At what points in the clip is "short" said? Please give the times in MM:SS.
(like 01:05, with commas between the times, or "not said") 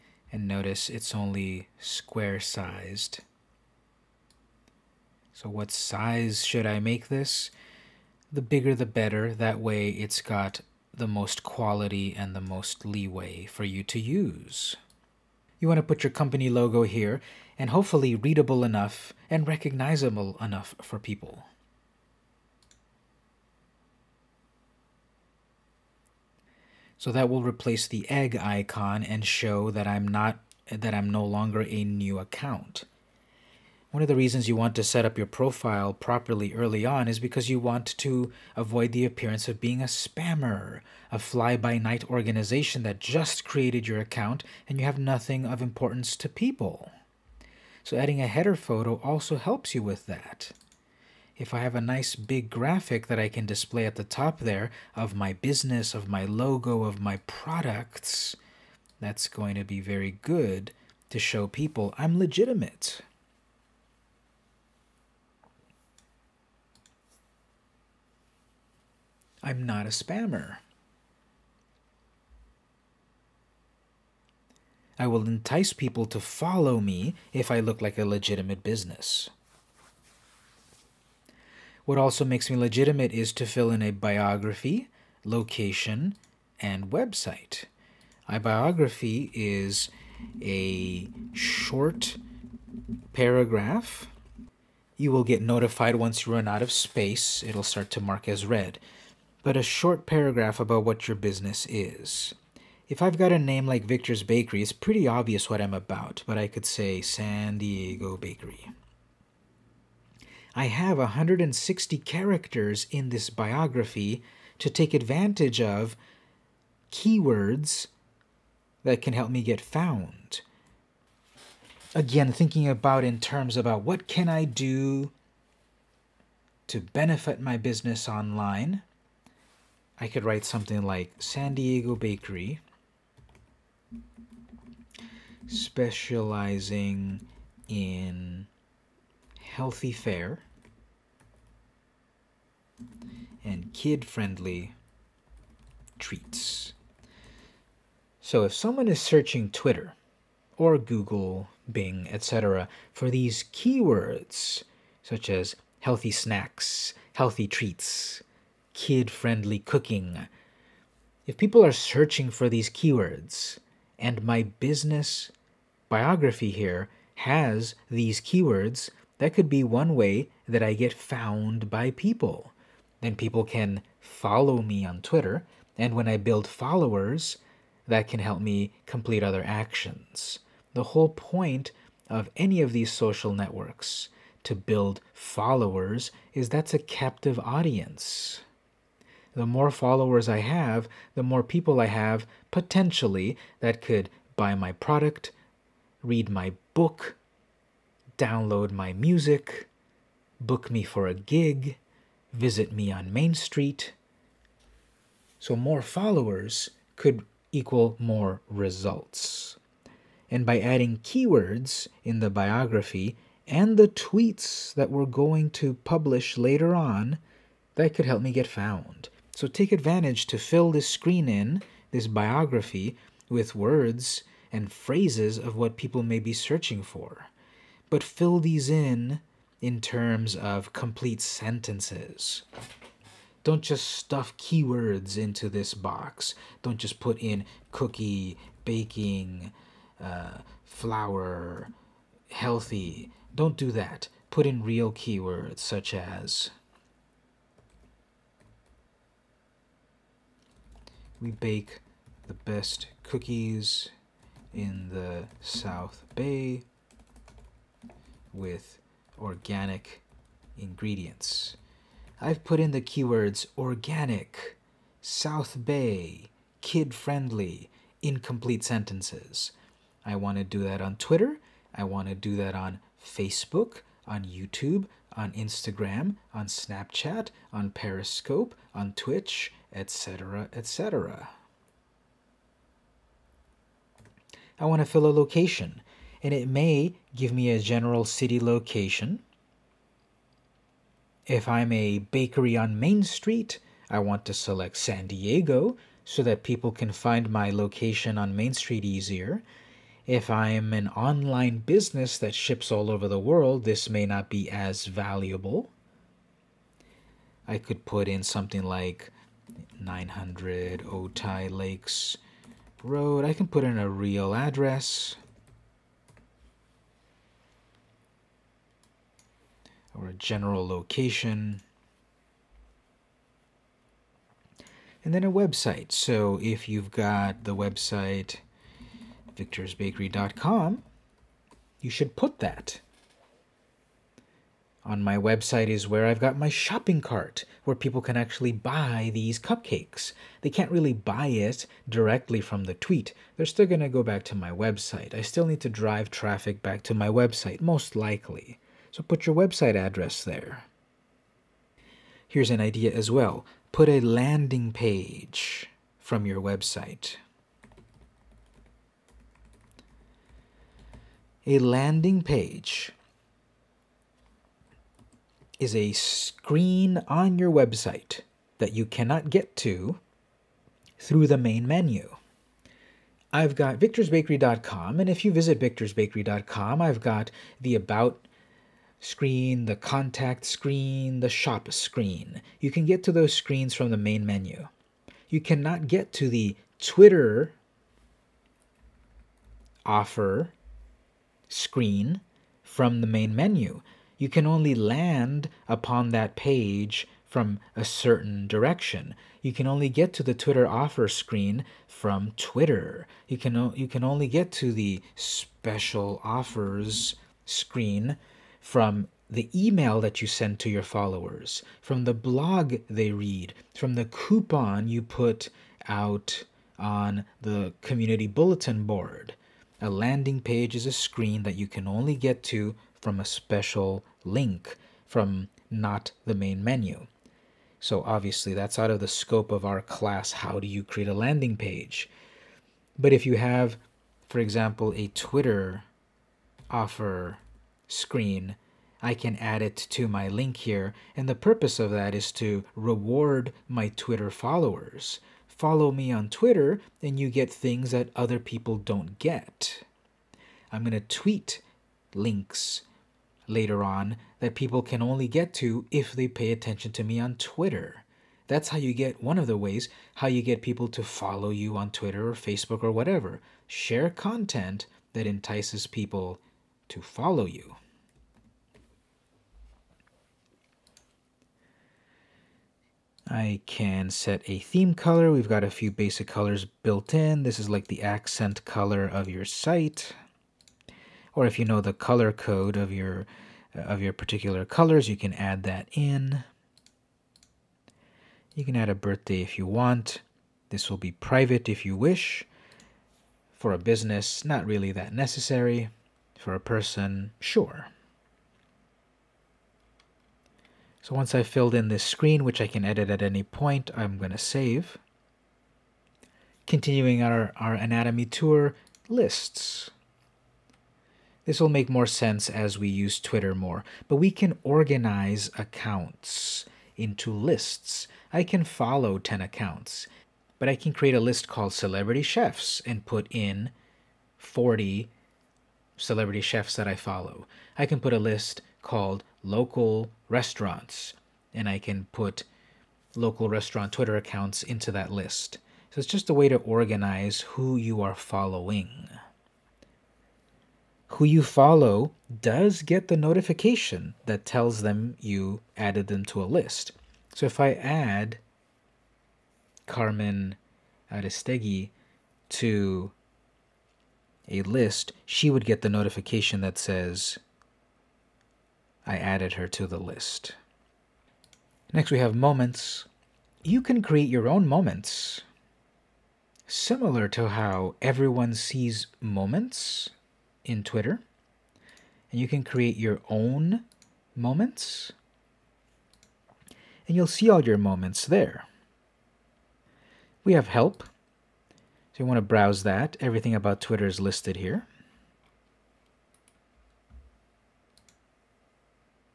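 01:31, 01:39.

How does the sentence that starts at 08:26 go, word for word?
Continuing our, our anatomy tour, lists.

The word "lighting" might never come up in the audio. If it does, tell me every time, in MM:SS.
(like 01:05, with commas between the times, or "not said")
not said.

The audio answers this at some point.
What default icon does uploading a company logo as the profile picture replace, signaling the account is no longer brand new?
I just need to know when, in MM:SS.
00:28.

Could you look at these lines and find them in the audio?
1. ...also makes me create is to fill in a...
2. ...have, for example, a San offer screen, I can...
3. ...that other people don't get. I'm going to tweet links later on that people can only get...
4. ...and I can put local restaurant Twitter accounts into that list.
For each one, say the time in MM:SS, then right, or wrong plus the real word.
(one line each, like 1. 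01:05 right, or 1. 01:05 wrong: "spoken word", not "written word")
1. 01:21 wrong: "legitimate", not "create"
2. 07:13 wrong: "Twitter", not "San"
3. 07:27 right
4. 08:51 right.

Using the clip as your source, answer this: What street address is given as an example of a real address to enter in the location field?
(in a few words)
900 Otay Lakes Road.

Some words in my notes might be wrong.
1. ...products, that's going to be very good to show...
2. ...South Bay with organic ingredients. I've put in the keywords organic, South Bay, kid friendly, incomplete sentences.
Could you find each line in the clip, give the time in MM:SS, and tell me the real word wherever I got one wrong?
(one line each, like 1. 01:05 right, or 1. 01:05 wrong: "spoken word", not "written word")
1. 00:57 right
2. 04:15 right.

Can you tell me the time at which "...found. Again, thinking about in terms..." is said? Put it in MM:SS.
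01:59.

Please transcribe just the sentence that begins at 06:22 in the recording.
You can get to those screens from the main menu.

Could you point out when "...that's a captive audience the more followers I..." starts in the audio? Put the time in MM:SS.
03:06.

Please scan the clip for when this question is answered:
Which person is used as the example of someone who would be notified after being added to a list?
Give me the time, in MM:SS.
09:09.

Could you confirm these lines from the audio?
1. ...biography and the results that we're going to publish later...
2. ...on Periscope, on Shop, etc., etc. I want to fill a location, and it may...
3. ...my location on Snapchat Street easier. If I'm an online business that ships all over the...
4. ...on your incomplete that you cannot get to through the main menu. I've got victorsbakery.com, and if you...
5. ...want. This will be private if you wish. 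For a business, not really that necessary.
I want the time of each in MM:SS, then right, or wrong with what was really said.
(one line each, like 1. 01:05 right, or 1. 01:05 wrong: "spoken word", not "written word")
1. 03:32 wrong: "tweets", not "results"
2. 04:37 wrong: "Twitch", not "Shop"
3. 04:57 wrong: "Main", not "Snapchat"
4. 06:07 wrong: "website", not "incomplete"
5. 08:09 right.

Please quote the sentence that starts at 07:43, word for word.
Share content that entices people to follow you.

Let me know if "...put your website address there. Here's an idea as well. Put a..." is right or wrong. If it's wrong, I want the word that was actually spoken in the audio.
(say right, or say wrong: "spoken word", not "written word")
right.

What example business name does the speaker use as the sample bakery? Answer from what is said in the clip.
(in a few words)
Victor's Bakery.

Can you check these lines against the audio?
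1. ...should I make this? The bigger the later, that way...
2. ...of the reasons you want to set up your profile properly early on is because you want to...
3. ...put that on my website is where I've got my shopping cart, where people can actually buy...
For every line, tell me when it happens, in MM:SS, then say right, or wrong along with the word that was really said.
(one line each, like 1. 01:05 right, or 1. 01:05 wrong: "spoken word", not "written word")
1. 00:06 wrong: "better", not "later"
2. 00:34 right
3. 05:32 right.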